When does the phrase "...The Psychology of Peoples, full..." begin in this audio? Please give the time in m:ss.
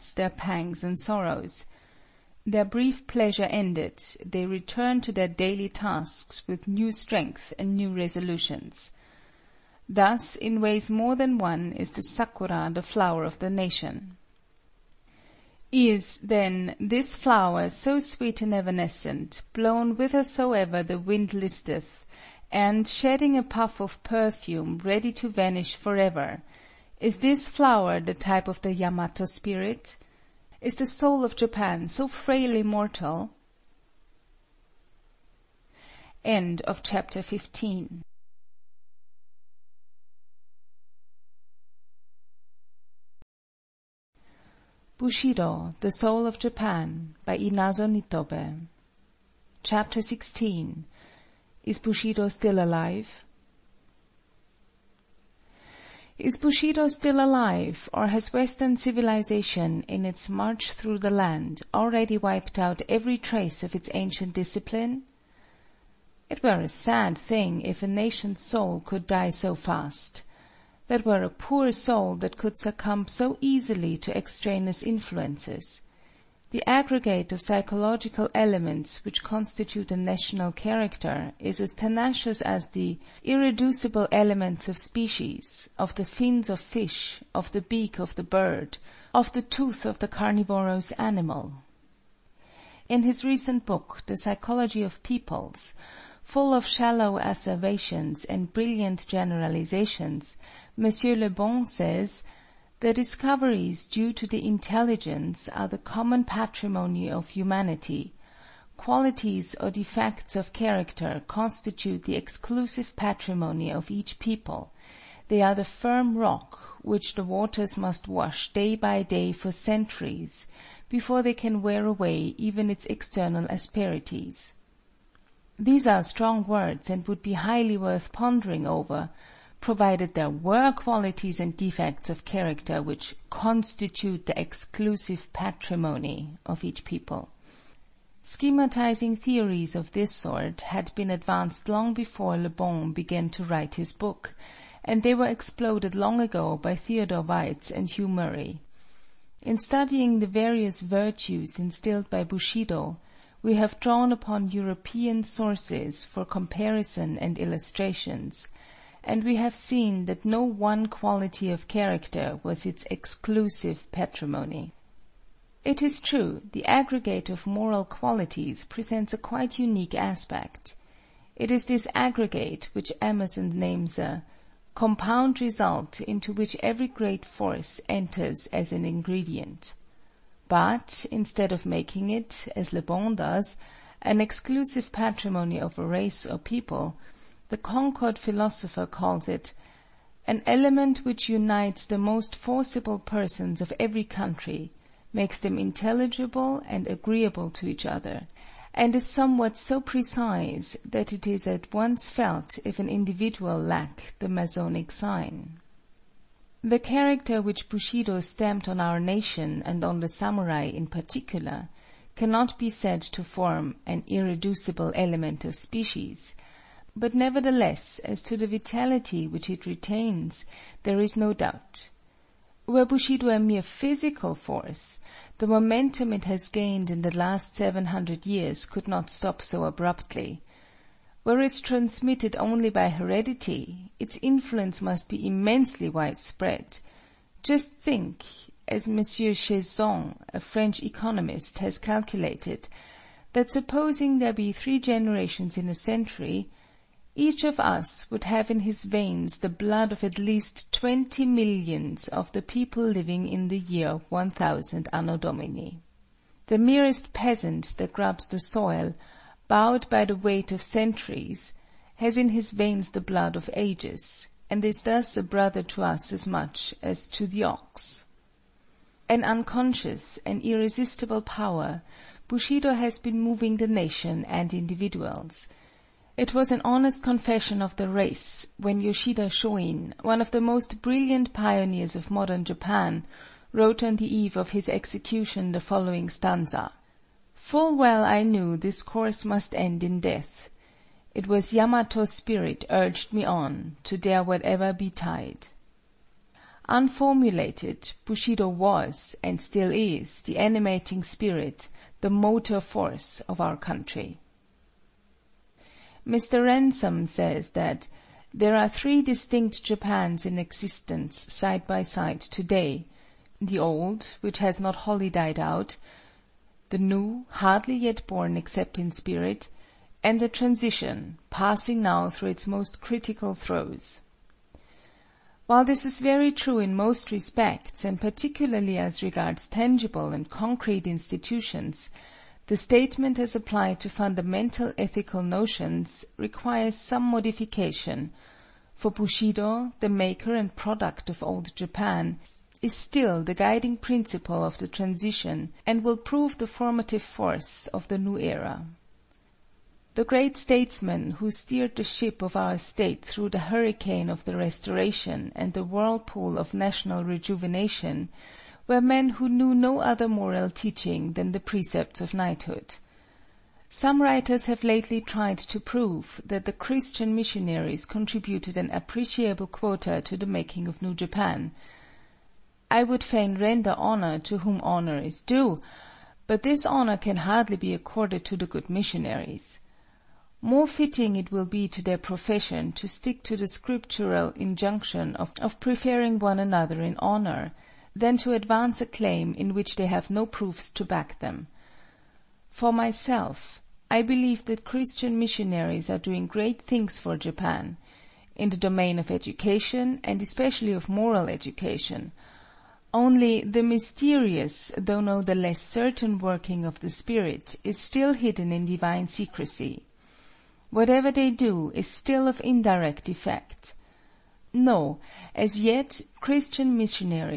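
1:34.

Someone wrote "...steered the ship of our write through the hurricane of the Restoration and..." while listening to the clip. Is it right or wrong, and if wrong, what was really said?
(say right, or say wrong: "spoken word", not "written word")
wrong: "state", not "write".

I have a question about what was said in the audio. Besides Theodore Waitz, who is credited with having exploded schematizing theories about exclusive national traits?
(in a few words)
Hugh Murray.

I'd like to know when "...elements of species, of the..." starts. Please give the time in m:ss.
1:24.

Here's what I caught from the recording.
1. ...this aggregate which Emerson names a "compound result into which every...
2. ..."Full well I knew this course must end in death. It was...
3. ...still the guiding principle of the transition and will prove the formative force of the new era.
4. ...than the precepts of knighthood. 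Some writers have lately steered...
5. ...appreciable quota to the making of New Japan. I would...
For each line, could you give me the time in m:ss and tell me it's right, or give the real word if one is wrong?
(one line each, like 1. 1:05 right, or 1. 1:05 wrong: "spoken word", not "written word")
1. 2:51 right
2. 4:47 right
3. 5:42 right
4. 6:01 wrong: "tried", not "steered"
5. 6:08 right.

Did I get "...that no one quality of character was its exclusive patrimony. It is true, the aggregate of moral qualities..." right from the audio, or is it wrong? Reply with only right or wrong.
right.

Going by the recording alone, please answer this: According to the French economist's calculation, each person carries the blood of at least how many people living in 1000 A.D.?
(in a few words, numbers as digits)
20 million.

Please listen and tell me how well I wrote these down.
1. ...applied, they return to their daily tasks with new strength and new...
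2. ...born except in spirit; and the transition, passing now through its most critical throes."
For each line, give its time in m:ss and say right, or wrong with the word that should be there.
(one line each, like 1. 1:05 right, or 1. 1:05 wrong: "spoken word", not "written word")
1. 0:03 wrong: "ended", not "applied"
2. 5:18 right.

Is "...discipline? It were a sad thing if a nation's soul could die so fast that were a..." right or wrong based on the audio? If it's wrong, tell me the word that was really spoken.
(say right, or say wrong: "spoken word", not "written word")
right.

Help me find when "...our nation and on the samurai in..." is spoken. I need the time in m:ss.
3:28.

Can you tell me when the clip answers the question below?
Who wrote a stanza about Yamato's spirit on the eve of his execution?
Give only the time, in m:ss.
4:38.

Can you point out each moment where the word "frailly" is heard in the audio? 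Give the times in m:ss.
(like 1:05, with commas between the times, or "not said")
0:32.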